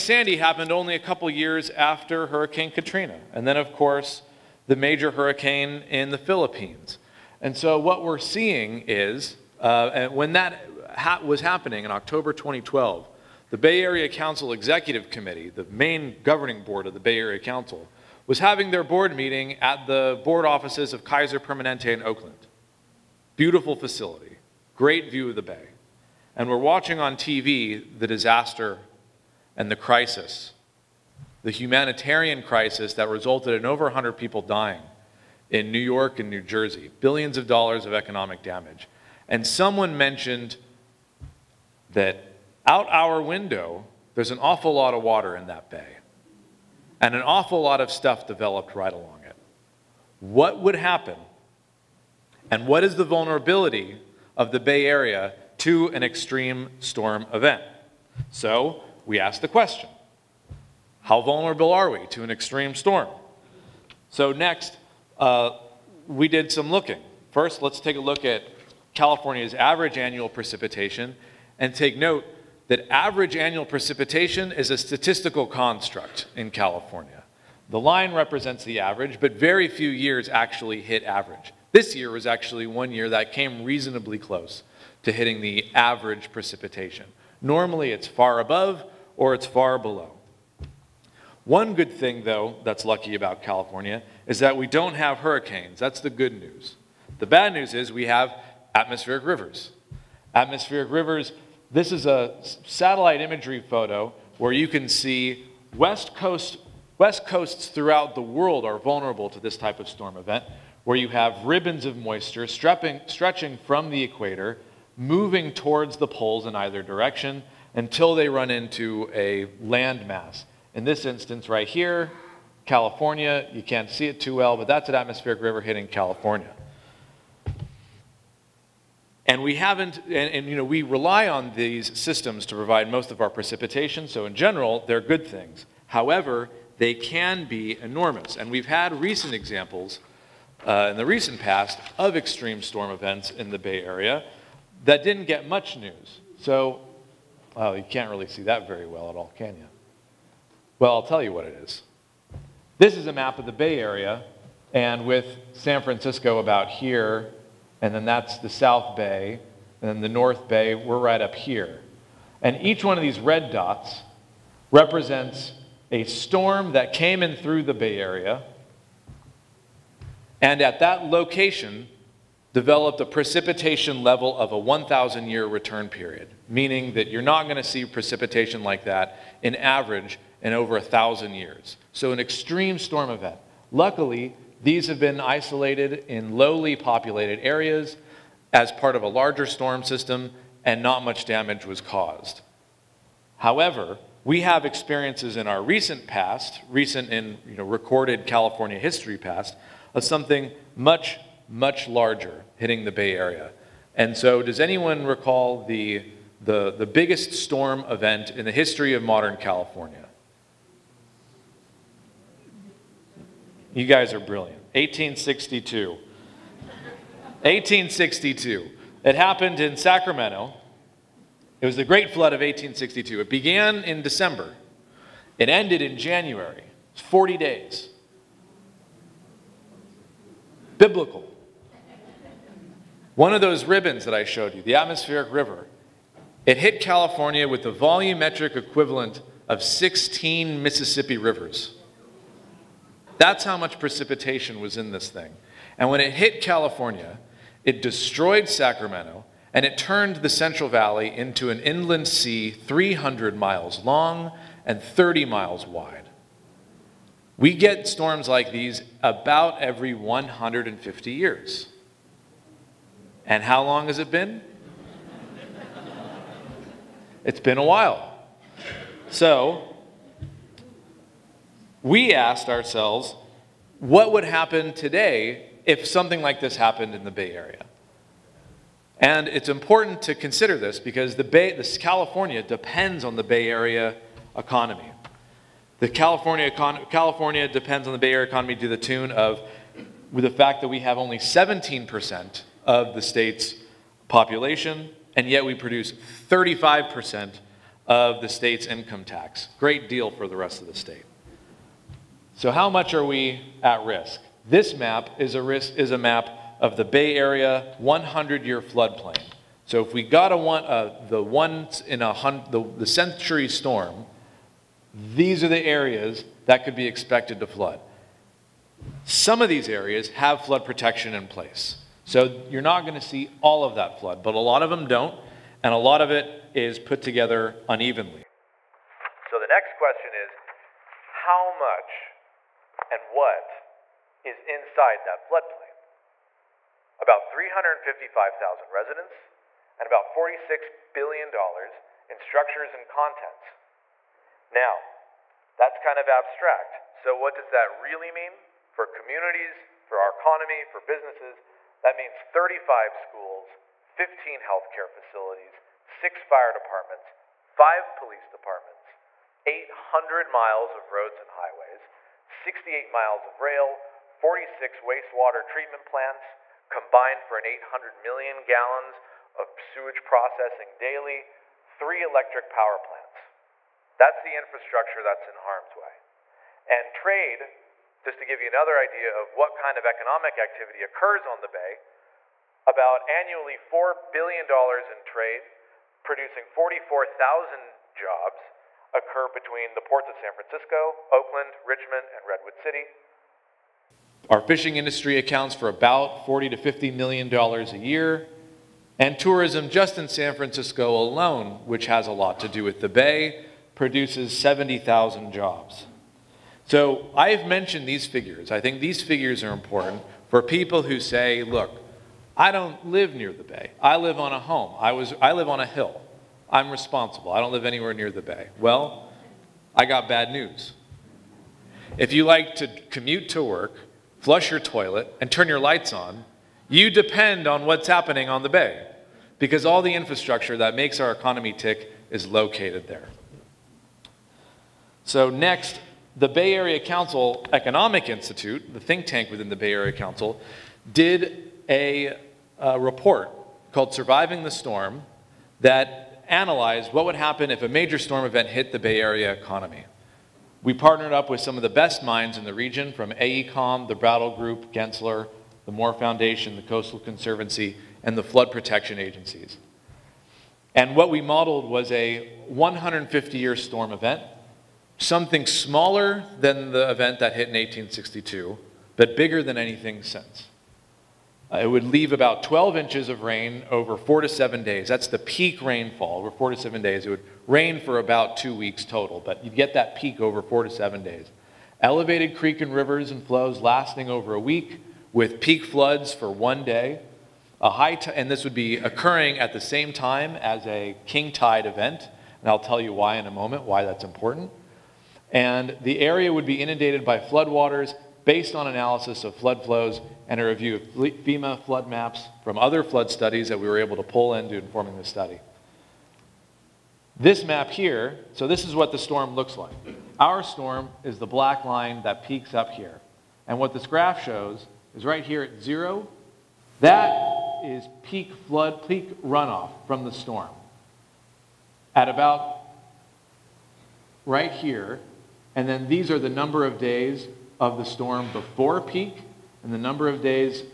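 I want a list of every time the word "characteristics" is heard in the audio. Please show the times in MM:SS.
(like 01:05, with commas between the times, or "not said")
not said.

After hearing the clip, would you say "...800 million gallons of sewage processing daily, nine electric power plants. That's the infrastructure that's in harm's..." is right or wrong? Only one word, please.
wrong.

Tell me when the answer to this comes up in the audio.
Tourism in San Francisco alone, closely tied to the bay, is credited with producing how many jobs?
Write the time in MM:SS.
06:44.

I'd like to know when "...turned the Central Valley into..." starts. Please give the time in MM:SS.
04:09.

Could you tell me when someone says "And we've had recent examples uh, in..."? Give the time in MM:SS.
02:18.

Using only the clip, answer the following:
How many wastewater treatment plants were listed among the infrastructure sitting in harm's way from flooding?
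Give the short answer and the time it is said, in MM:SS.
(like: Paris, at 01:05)
46, at 06:04.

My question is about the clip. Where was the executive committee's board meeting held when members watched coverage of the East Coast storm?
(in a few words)
Kaiser Permanente in Oakland.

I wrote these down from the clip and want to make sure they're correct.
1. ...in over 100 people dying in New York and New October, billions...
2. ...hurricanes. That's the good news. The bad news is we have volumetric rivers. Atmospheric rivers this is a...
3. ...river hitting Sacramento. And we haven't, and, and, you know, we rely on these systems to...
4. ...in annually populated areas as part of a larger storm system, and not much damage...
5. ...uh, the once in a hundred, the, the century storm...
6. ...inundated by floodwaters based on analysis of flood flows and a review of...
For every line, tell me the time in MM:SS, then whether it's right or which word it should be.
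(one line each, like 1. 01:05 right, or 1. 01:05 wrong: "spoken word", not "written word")
1. 00:33 wrong: "Jersey", not "October"
2. 01:35 wrong: "atmospheric", not "volumetric"
3. 02:05 wrong: "California", not "Sacramento"
4. 03:06 wrong: "lowly", not "annually"
5. 05:10 right
6. 08:16 right.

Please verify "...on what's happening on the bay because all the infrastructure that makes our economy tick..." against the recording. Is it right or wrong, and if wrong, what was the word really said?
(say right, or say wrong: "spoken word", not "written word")
right.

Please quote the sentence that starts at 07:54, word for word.
That's the peak rainfall over four to seven days.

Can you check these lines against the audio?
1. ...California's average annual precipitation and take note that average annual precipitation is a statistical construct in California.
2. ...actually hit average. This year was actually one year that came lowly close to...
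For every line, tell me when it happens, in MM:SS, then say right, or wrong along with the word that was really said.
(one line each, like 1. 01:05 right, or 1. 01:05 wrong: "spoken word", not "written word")
1. 01:08 right
2. 01:20 wrong: "reasonably", not "lowly".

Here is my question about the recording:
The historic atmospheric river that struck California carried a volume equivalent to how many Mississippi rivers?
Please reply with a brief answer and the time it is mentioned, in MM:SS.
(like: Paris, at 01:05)
16, at 03:59.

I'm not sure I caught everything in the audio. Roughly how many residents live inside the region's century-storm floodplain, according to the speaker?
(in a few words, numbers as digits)
355,000.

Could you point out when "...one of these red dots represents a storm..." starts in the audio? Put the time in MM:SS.
02:42.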